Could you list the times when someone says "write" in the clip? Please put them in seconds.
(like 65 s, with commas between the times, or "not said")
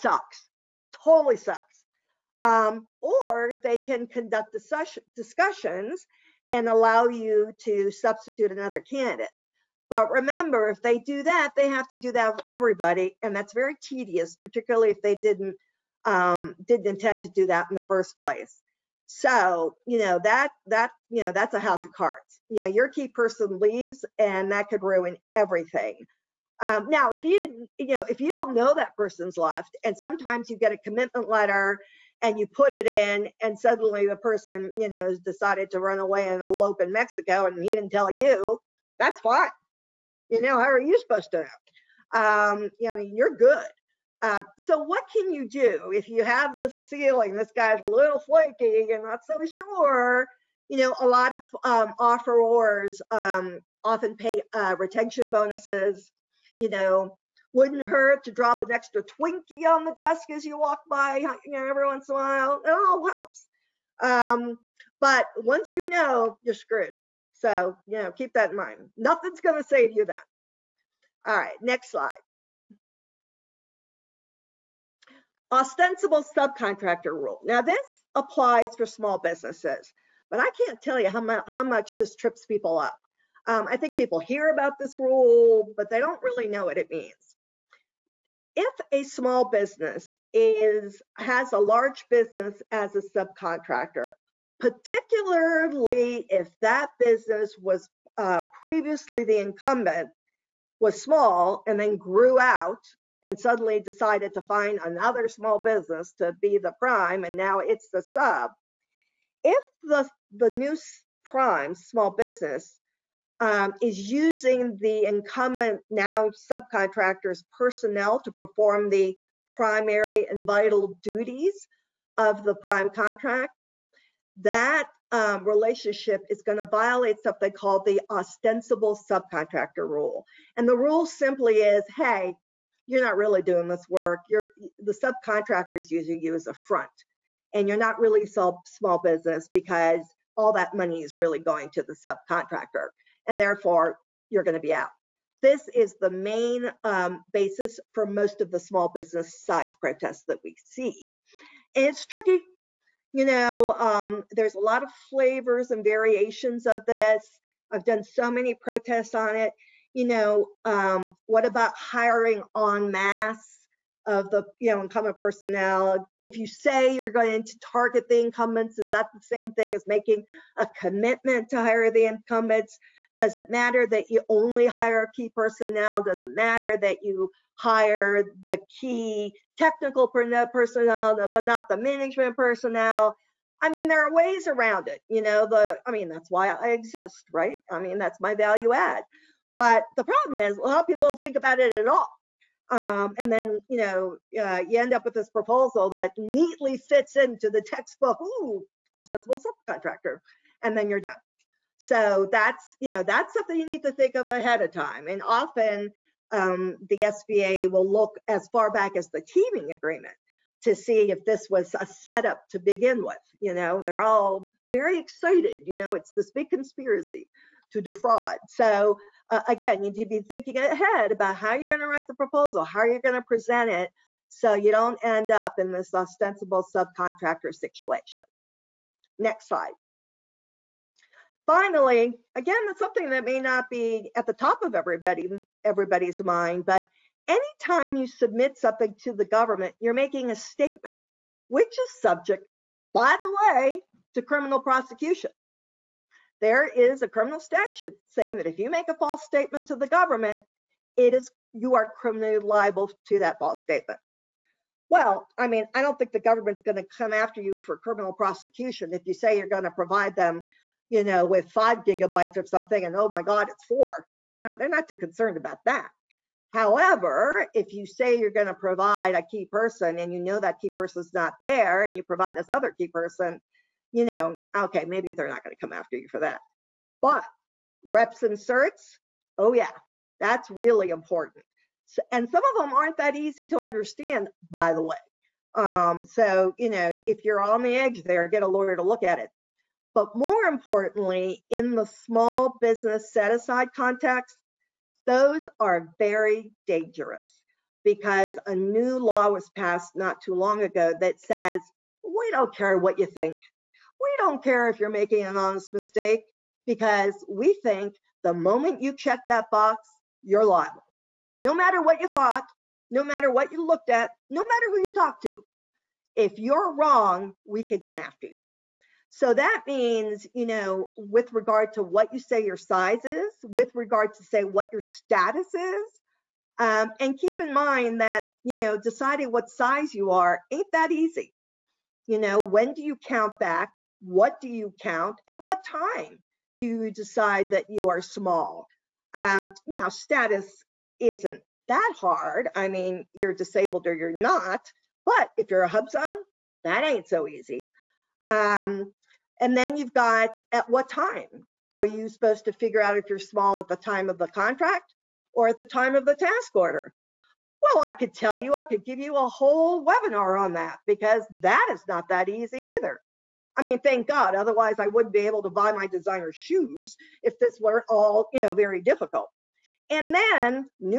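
221 s.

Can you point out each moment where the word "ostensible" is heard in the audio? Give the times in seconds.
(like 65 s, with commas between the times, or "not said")
75 s, 128 s, 198 s, 225 s.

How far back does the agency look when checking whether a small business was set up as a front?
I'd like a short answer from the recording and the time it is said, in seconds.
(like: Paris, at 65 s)
the teaming agreement, at 209 s.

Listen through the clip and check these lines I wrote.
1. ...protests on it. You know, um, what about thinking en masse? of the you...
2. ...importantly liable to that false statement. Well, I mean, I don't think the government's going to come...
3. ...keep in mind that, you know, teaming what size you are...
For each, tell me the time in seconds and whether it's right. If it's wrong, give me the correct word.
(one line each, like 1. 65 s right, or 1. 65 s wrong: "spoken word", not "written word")
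1. 158 s wrong: "hiring", not "thinking"
2. 251 s wrong: "criminally", not "importantly"
3. 327 s wrong: "deciding", not "teaming".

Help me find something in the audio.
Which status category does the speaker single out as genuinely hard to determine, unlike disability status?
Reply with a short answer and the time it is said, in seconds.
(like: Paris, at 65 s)
HUBZone, at 345 s.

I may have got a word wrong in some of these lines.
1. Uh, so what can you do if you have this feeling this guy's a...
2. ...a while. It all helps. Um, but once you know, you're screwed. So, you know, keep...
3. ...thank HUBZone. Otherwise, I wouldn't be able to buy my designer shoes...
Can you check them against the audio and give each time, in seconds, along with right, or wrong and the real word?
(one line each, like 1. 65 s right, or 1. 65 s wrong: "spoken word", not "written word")
1. 44 s right
2. 62 s right
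3. 363 s wrong: "God", not "HUBZone".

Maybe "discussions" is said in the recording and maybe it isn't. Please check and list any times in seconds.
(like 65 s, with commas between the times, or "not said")
5 s.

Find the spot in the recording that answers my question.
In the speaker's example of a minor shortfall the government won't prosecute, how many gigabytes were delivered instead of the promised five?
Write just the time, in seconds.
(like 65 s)
263 s.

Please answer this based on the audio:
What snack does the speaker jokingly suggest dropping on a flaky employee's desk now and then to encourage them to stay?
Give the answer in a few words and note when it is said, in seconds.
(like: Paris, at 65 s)
Twinkie, at 59 s.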